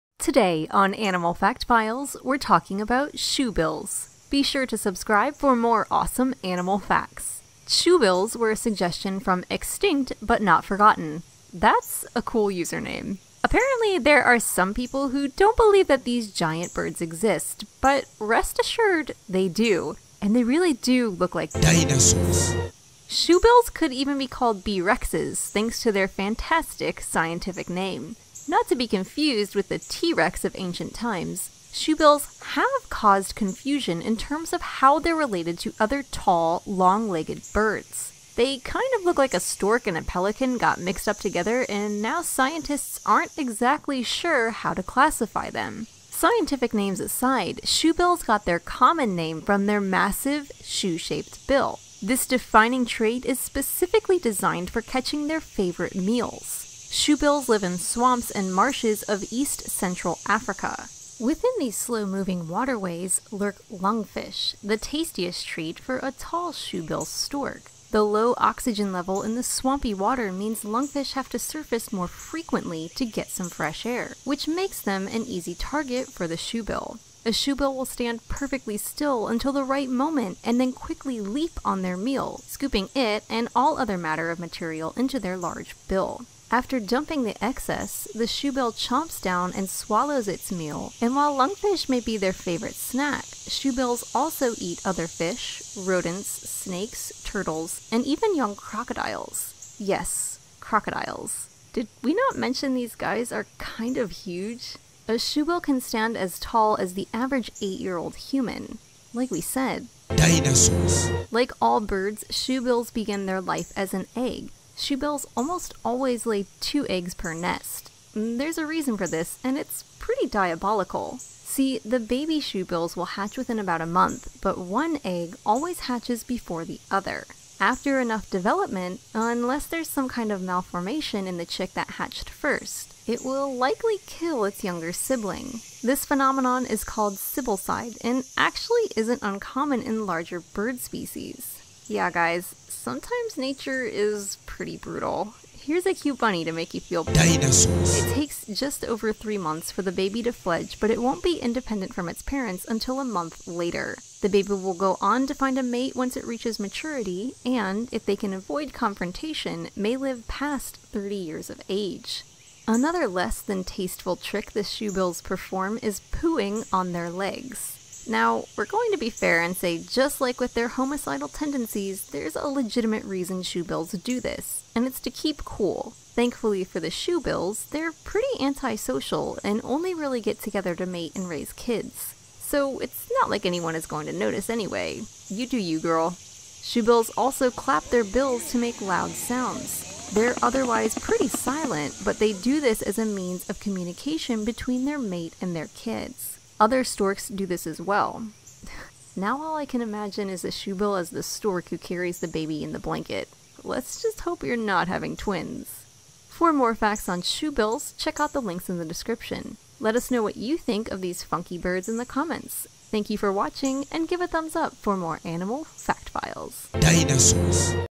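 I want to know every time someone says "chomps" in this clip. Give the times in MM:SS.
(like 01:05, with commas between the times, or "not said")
01:28.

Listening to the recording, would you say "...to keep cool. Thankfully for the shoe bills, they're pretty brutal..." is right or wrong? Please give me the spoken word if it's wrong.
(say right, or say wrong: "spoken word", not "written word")
wrong: "antisocial", not "brutal".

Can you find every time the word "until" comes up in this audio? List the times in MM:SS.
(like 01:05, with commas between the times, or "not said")
01:19, 02:32.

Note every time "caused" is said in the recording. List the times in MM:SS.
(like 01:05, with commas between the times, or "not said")
00:32.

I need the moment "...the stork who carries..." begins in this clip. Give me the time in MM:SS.
03:21.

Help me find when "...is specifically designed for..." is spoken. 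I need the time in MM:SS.
00:53.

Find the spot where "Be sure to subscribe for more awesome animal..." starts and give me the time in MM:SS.
00:04.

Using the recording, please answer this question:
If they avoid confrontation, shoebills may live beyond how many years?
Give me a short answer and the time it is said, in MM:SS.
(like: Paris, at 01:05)
30, at 02:40.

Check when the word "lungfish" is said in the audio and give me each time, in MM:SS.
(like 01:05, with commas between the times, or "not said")
01:03, 01:10, 01:31.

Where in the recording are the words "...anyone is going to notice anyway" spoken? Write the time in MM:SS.
03:03.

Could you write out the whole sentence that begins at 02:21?
Yeah, guys, sometimes nature is pretty brutal.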